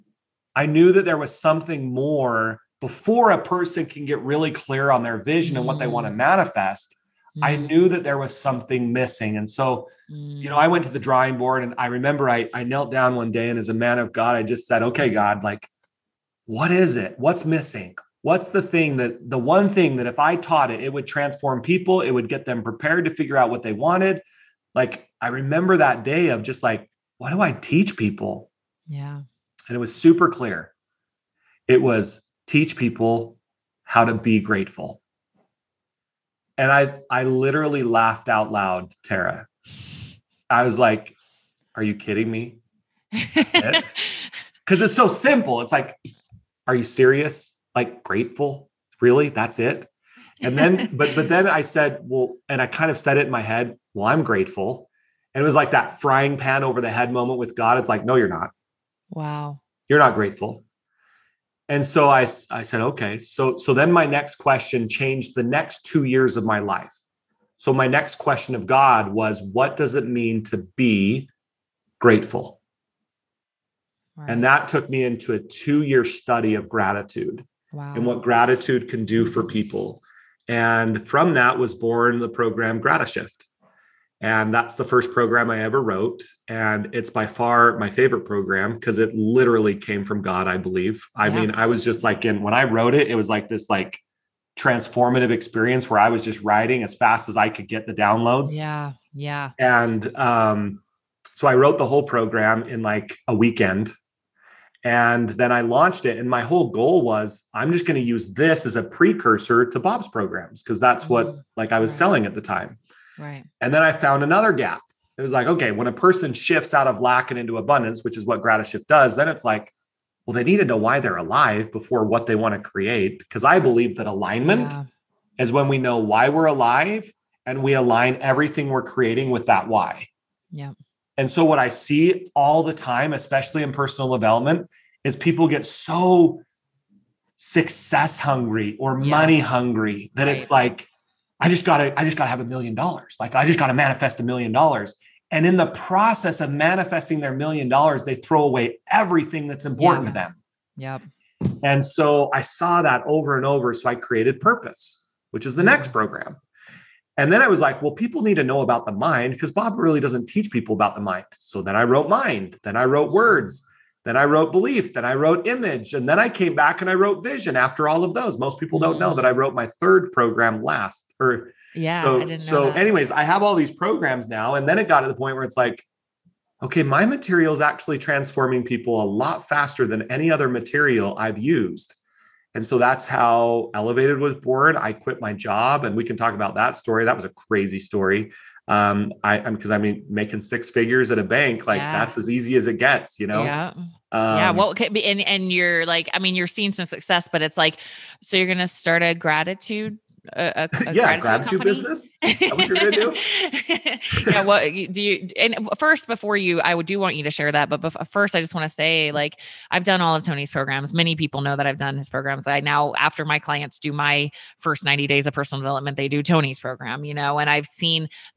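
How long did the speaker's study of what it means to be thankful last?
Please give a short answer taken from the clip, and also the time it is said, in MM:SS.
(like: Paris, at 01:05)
2 years, at 01:15.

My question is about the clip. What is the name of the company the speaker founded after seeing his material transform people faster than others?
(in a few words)
Elevated.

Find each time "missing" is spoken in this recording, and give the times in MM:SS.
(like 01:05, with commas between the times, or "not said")
00:08, 00:17.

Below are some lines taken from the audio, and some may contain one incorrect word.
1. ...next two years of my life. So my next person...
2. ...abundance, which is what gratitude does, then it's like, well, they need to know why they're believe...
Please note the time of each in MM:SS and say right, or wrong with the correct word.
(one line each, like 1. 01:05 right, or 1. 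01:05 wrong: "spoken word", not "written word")
1. 01:05 wrong: "question", not "person"
2. 01:57 wrong: "alive", not "believe".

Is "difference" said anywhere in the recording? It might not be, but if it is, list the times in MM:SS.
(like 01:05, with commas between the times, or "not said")
not said.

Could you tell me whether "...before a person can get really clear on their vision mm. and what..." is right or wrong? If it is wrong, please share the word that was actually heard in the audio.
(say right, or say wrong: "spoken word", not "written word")
right.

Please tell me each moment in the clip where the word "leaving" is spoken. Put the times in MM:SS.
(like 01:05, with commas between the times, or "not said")
not said.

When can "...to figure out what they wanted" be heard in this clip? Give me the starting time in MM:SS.
00:23.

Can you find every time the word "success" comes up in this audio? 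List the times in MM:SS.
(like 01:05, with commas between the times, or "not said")
02:17, 03:16.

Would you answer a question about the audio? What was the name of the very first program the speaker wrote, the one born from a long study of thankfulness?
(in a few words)
Gratishift.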